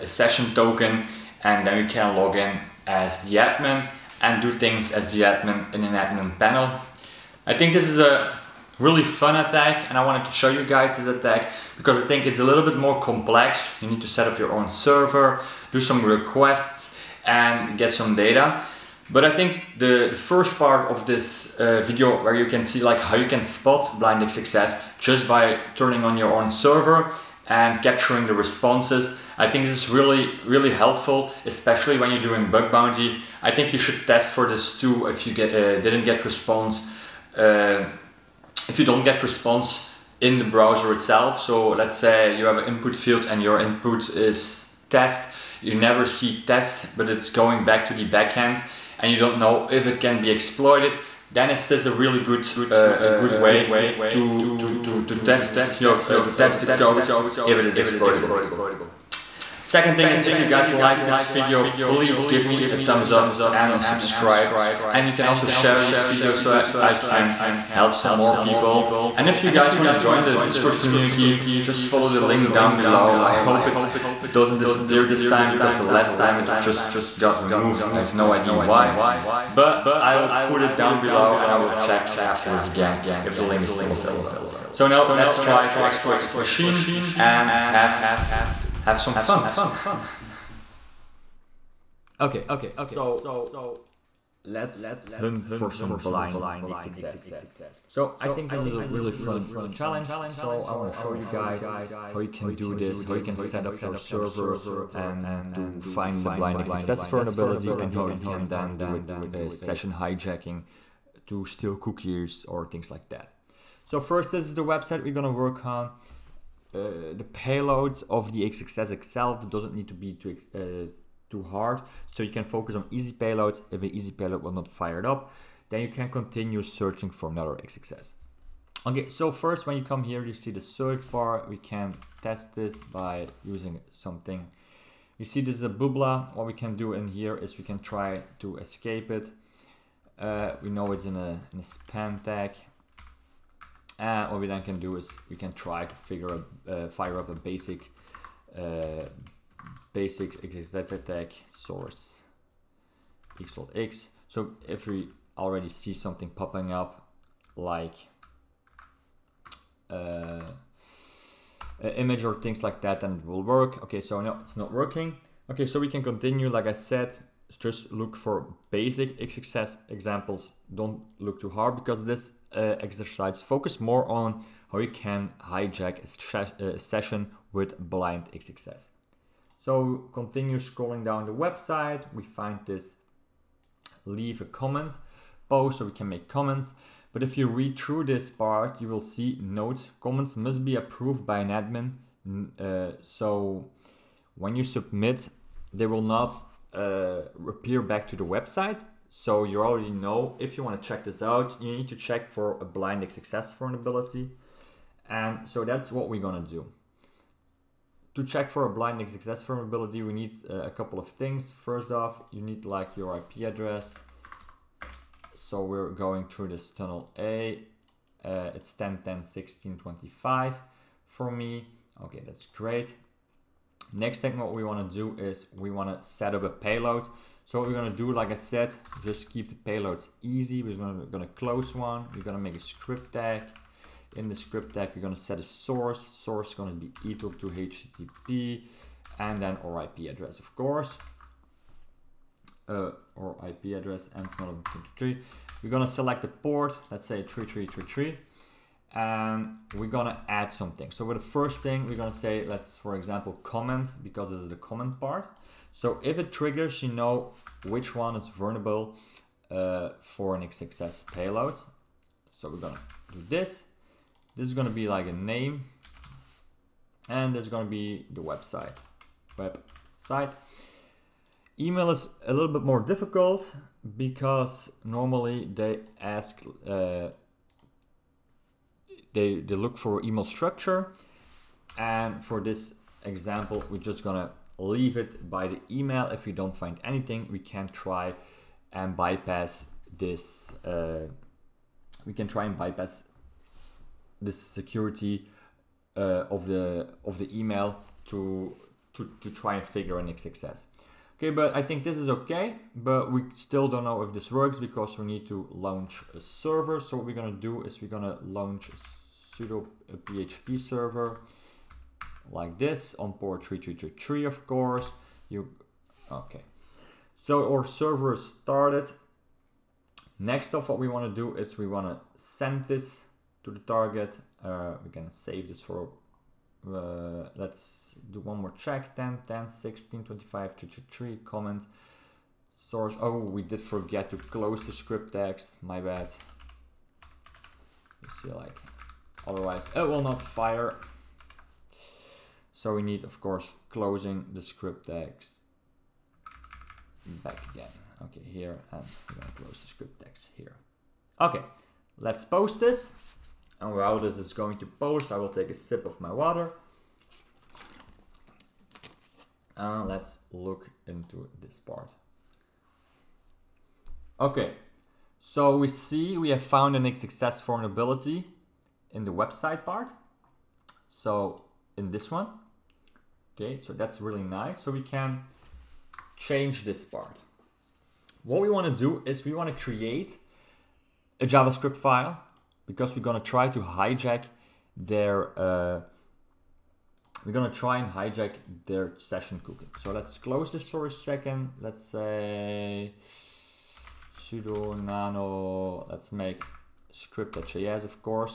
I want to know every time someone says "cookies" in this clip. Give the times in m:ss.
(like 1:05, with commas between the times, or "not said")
1:51, 6:29.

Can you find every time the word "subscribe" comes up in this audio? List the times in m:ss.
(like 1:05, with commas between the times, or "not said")
1:03.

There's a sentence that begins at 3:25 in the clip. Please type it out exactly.
And so that's what we're going to do.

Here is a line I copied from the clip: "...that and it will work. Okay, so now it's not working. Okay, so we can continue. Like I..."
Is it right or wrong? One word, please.
right.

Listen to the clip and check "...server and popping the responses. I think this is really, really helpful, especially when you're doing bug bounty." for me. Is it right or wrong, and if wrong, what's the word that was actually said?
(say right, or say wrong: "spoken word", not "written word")
wrong: "capturing", not "popping".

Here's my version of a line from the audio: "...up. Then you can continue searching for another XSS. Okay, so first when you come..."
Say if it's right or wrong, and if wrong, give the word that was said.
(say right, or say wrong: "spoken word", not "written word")
wrong: "XXS", not "XSS".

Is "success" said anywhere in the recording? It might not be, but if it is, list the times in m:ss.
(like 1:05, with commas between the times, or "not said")
0:24, 1:46, 2:49, 2:58, 3:29.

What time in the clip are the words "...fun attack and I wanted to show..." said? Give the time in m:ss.
0:09.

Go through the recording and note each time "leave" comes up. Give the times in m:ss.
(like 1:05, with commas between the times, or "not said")
3:04, 4:44.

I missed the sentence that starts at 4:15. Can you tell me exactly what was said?
So if it triggers, you know which one is vulnerable uh, for an XSS payload.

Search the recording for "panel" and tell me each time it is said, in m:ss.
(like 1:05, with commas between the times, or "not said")
0:06.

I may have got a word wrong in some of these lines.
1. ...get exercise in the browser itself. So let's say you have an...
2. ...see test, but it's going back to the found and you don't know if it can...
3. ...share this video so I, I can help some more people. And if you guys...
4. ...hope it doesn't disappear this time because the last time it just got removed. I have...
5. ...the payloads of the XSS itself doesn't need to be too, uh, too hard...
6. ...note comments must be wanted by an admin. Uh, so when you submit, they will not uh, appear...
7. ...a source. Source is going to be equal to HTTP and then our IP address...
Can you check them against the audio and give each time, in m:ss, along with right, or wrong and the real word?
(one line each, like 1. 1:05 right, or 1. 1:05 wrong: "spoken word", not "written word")
1. 0:39 wrong: "response", not "exercise"
2. 0:46 wrong: "backend", not "found"
3. 1:05 right
4. 1:13 right
5. 1:57 right
6. 3:09 wrong: "approved", not "wanted"
7. 3:55 right.